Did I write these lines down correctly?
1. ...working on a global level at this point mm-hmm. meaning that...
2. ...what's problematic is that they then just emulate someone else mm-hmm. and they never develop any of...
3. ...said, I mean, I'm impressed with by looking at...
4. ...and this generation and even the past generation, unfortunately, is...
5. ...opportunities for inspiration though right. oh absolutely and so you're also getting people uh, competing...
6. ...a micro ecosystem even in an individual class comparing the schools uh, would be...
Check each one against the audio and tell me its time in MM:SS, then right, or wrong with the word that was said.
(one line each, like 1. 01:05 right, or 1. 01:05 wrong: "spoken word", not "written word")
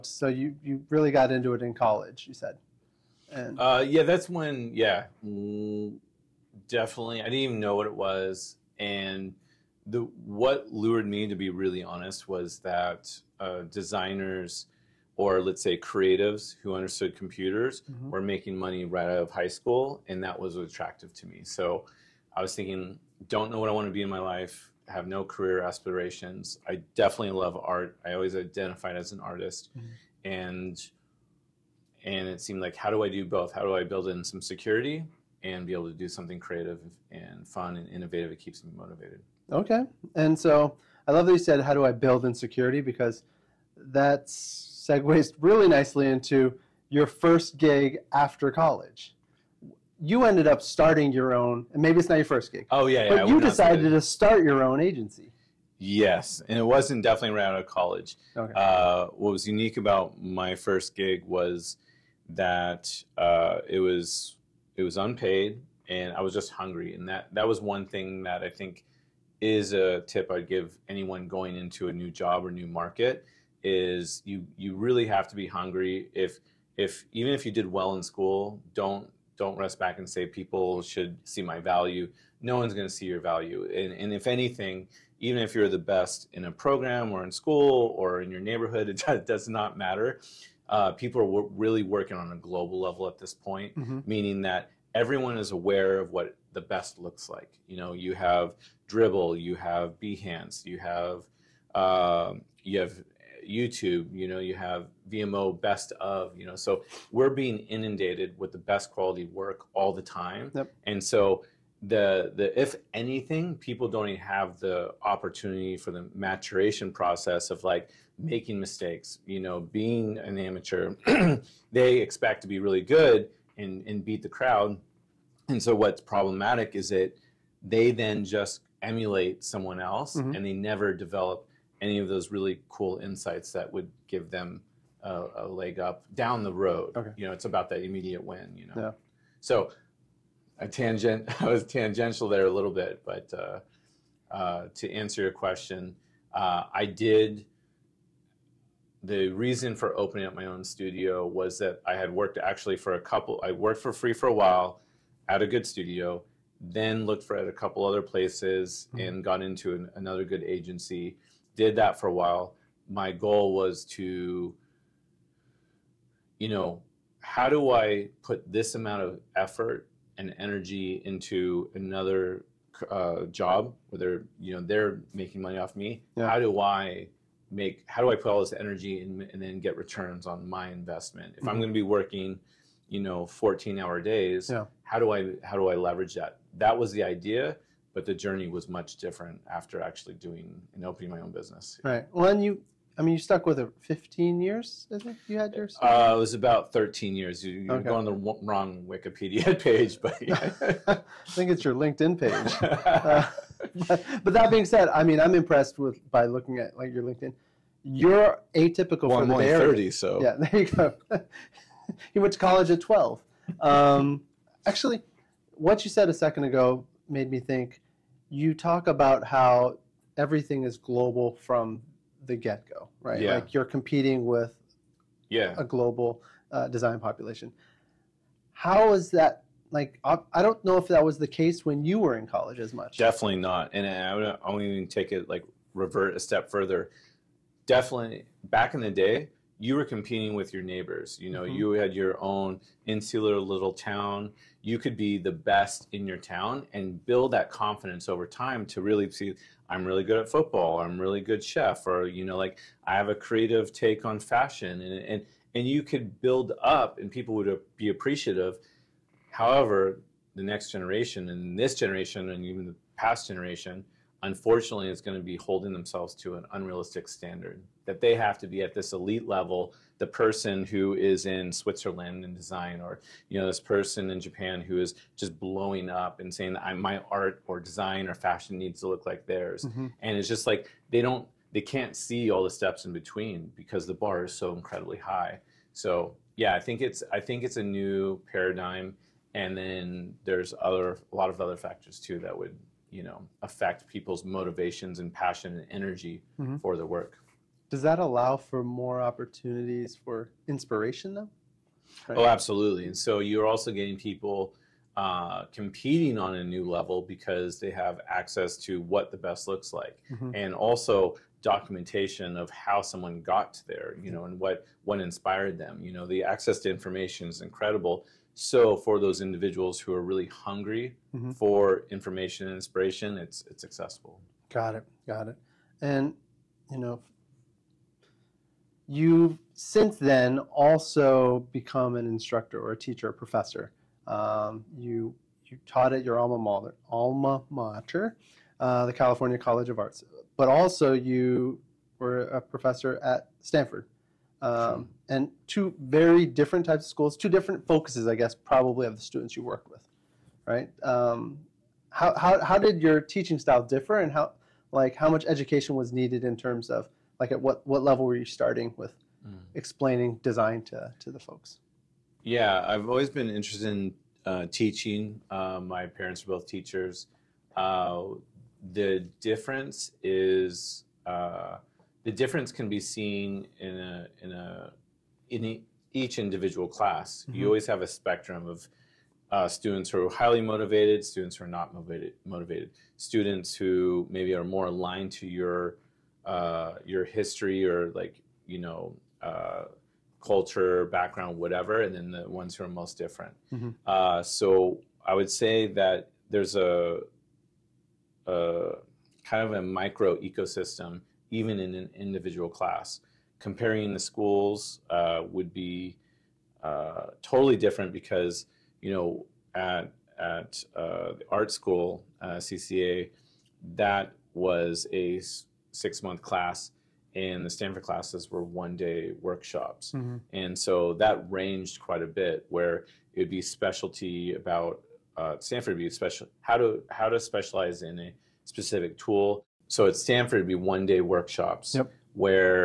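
1. 01:31 right
2. 02:05 right
3. 03:24 right
4. 04:21 right
5. 04:58 right
6. 06:39 right.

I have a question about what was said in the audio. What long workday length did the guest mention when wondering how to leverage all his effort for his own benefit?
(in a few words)
14 hour days.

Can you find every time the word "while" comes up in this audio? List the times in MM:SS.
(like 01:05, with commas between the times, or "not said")
02:34, 02:42.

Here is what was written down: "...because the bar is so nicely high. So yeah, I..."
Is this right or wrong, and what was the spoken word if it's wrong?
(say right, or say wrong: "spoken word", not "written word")
wrong: "incredibly", not "nicely".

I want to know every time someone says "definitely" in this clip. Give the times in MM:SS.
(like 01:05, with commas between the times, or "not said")
00:06, 00:26, 00:57, 03:52, 03:57.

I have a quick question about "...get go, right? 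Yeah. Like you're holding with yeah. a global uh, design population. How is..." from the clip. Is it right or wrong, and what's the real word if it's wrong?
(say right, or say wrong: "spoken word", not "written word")
wrong: "competing", not "holding".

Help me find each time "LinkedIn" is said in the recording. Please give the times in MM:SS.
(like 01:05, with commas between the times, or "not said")
03:21, 03:27.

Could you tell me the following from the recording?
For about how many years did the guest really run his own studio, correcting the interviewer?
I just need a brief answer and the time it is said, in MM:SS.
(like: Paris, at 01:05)
13 years, at 03:16.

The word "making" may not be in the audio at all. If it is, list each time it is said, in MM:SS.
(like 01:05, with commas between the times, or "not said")
00:18, 01:58, 02:55.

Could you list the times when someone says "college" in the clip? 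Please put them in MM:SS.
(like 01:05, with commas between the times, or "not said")
00:01, 00:48, 00:57, 03:32, 03:52, 05:39.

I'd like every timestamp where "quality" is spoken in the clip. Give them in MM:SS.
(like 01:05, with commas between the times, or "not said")
01:48.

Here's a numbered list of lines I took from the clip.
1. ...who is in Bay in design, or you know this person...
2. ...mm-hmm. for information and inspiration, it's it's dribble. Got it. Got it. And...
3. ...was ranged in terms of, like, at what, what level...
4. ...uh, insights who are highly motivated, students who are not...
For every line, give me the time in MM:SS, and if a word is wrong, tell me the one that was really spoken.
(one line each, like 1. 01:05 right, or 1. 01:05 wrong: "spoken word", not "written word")
1. 04:30 wrong: "Switzerland", not "Bay"
2. 05:21 wrong: "accessible", not "dribble"
3. 05:55 wrong: "needed", not "ranged"
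4. 06:19 wrong: "students", not "insights".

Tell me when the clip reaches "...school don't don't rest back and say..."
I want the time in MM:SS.
01:18.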